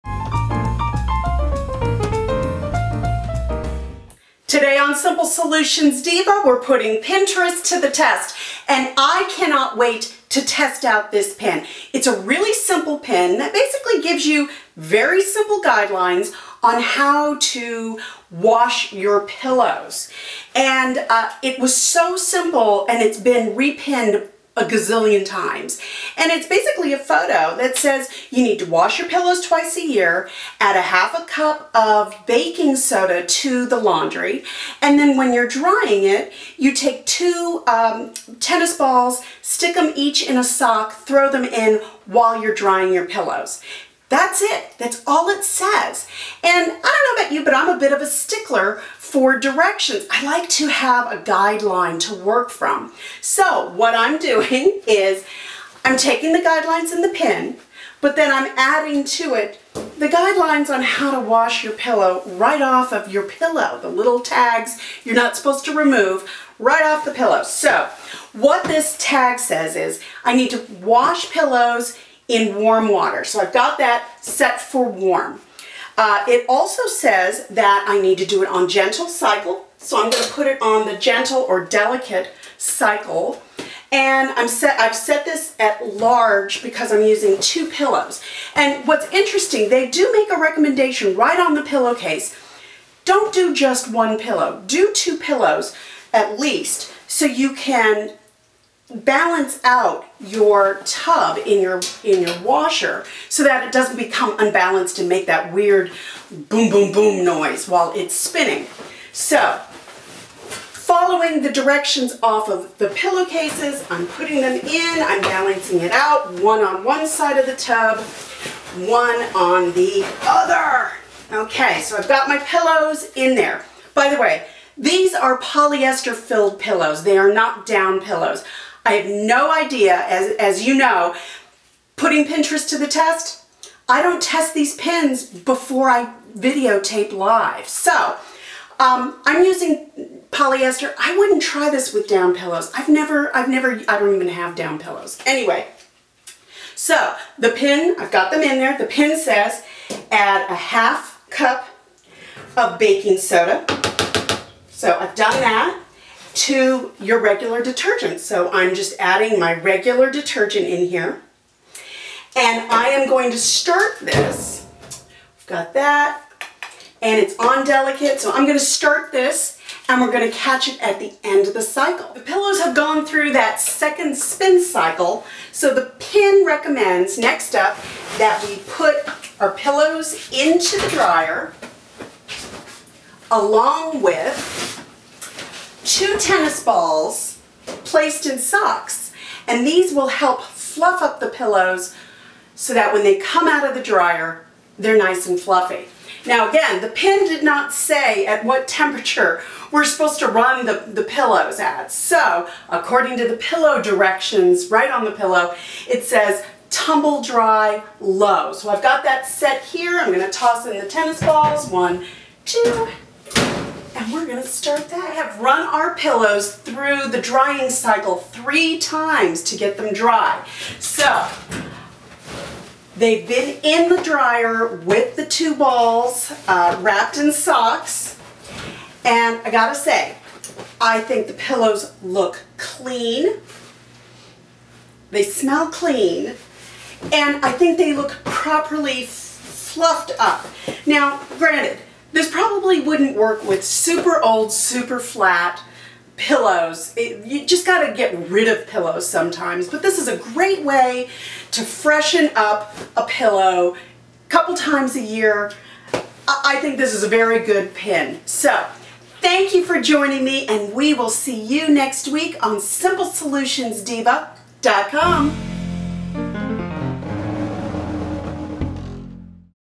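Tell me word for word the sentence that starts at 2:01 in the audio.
Okay, so I've got my pillows in there.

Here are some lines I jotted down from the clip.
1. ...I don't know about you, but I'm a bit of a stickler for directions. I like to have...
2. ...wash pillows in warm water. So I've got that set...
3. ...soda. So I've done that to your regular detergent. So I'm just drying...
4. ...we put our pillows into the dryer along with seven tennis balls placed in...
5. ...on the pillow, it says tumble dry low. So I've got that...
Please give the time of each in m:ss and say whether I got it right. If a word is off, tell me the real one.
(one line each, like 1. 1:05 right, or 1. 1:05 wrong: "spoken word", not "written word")
1. 0:46 right
2. 1:10 right
3. 2:33 wrong: "adding", not "drying"
4. 2:58 wrong: "two", not "seven"
5. 3:24 right.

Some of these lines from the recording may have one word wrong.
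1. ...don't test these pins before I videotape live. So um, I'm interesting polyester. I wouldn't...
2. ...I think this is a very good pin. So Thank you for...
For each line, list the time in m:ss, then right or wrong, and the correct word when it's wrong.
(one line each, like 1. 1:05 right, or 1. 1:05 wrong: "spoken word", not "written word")
1. 2:14 wrong: "using", not "interesting"
2. 4:16 right.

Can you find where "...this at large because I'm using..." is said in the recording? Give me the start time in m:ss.
1:25.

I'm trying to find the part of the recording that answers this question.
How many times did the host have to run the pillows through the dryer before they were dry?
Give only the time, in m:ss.
3:38.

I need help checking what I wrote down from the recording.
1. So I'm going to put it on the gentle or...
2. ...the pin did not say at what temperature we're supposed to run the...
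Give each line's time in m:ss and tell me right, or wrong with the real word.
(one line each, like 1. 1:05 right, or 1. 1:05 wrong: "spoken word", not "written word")
1. 1:19 right
2. 3:16 right.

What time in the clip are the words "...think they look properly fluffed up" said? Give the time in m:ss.
3:57.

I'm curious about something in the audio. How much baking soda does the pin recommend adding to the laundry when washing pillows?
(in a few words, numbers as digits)
half a cup.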